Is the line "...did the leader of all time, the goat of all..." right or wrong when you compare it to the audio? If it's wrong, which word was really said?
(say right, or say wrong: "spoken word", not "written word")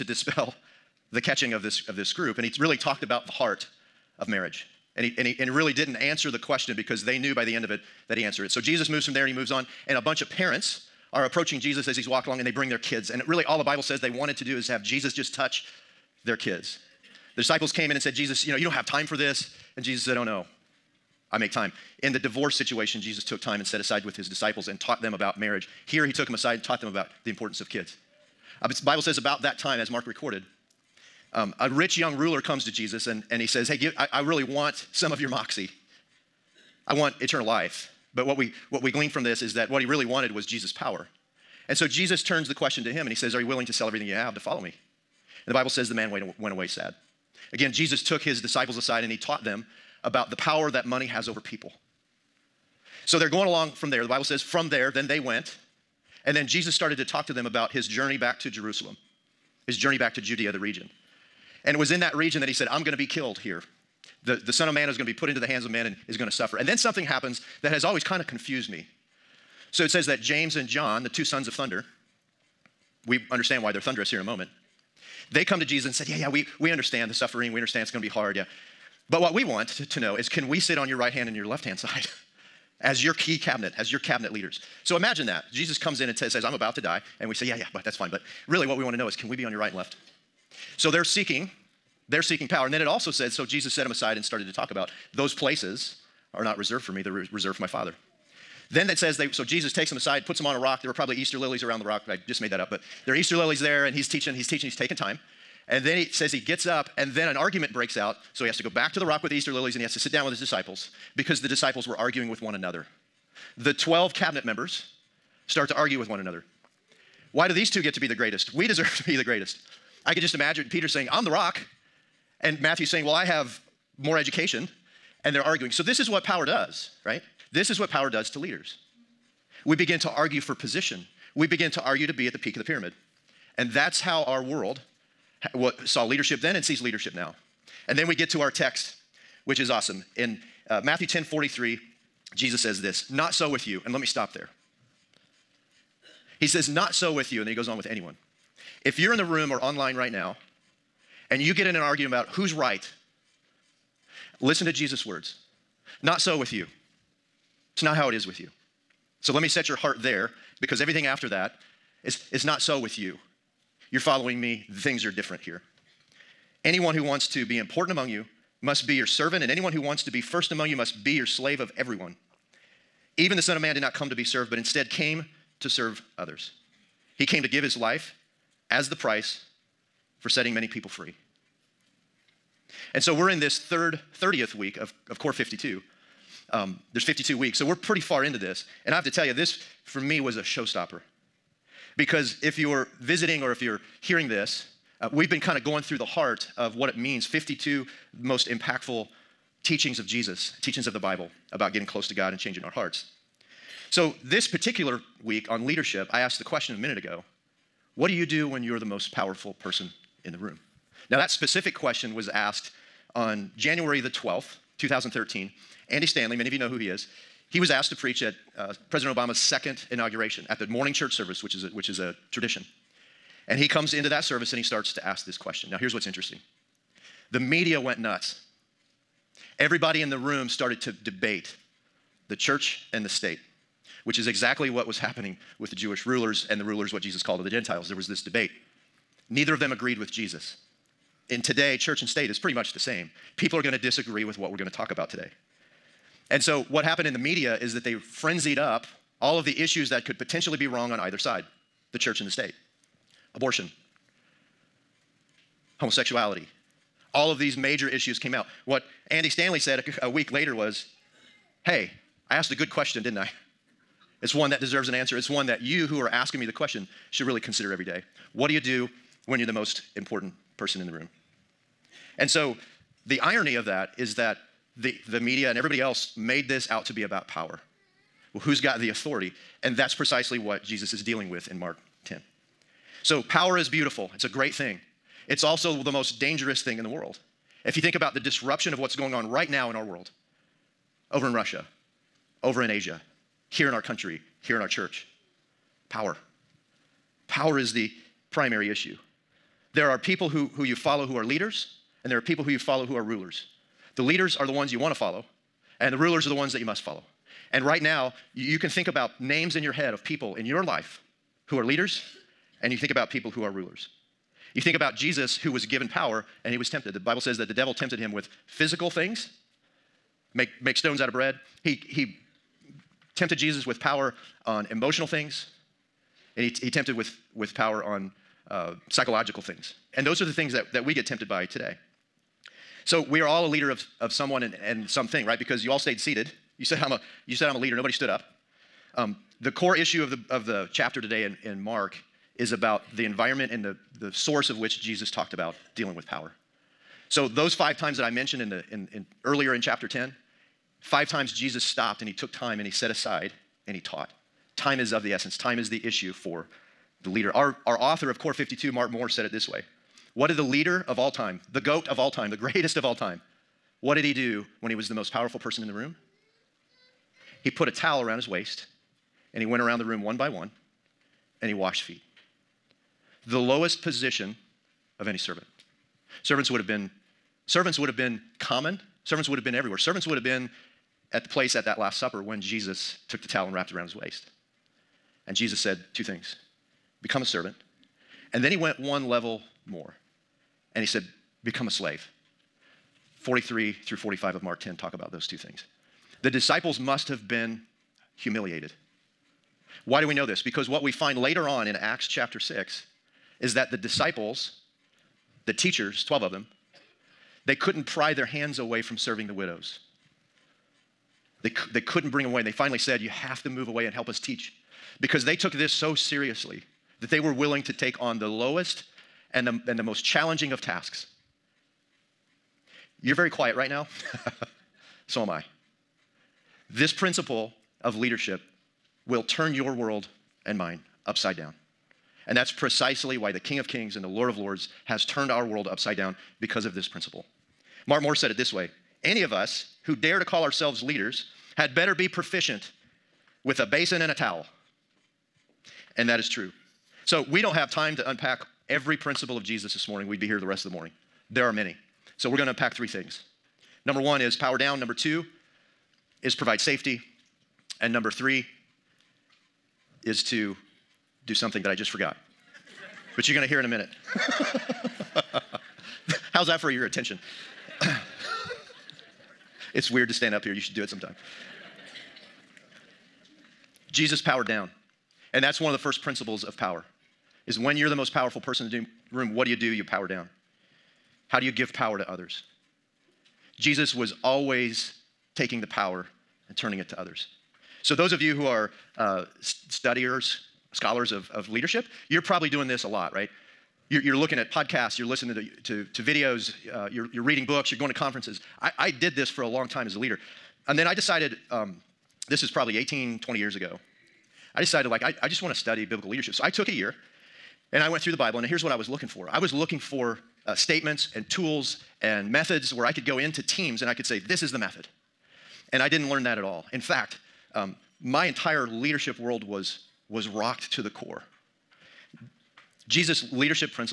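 right.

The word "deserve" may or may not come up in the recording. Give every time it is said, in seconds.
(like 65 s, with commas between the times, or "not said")
118 s, 264 s.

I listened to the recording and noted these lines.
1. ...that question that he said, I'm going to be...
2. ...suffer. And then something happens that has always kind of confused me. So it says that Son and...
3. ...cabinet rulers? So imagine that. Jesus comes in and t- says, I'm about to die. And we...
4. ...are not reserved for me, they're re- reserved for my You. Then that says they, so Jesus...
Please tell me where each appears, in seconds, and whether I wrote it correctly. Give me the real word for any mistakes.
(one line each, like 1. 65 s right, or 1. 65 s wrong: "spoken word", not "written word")
1. 61 s wrong: "region", not "question"
2. 66 s wrong: "James", not "Son"
3. 83 s wrong: "leaders", not "rulers"
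4. 96 s wrong: "Father", not "You".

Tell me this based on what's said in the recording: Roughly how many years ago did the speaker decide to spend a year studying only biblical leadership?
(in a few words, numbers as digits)
18 to 20 years.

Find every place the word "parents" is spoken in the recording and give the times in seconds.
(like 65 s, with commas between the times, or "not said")
10 s.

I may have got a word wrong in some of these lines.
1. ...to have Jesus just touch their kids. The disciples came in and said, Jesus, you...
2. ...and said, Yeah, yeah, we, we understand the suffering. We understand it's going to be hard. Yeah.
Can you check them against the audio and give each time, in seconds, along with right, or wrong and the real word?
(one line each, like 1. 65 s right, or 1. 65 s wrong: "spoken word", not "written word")
1. 14 s right
2. 75 s right.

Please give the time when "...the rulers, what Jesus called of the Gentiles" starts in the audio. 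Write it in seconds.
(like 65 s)
236 s.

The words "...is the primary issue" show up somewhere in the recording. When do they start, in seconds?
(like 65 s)
297 s.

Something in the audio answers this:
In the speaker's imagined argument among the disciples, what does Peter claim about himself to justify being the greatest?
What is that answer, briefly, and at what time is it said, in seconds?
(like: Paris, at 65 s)
I'm the rock, at 121 s.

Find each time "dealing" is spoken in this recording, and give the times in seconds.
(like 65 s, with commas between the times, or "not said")
281 s, 345 s.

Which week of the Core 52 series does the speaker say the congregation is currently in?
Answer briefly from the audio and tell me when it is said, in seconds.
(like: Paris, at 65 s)
30th, at 184 s.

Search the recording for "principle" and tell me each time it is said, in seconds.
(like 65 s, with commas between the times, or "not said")
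426 s, 436 s, 448 s, 476 s.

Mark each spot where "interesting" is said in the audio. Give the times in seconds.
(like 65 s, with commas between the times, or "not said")
226 s.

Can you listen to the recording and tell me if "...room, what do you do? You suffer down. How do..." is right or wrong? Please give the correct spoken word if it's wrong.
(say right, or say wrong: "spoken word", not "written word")
wrong: "power", not "suffer".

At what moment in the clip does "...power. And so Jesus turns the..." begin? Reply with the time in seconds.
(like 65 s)
40 s.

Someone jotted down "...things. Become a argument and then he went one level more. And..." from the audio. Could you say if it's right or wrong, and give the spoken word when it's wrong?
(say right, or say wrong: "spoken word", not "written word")
wrong: "servant", not "argument".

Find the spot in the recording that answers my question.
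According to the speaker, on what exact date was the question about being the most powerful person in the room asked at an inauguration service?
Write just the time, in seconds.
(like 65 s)
213 s.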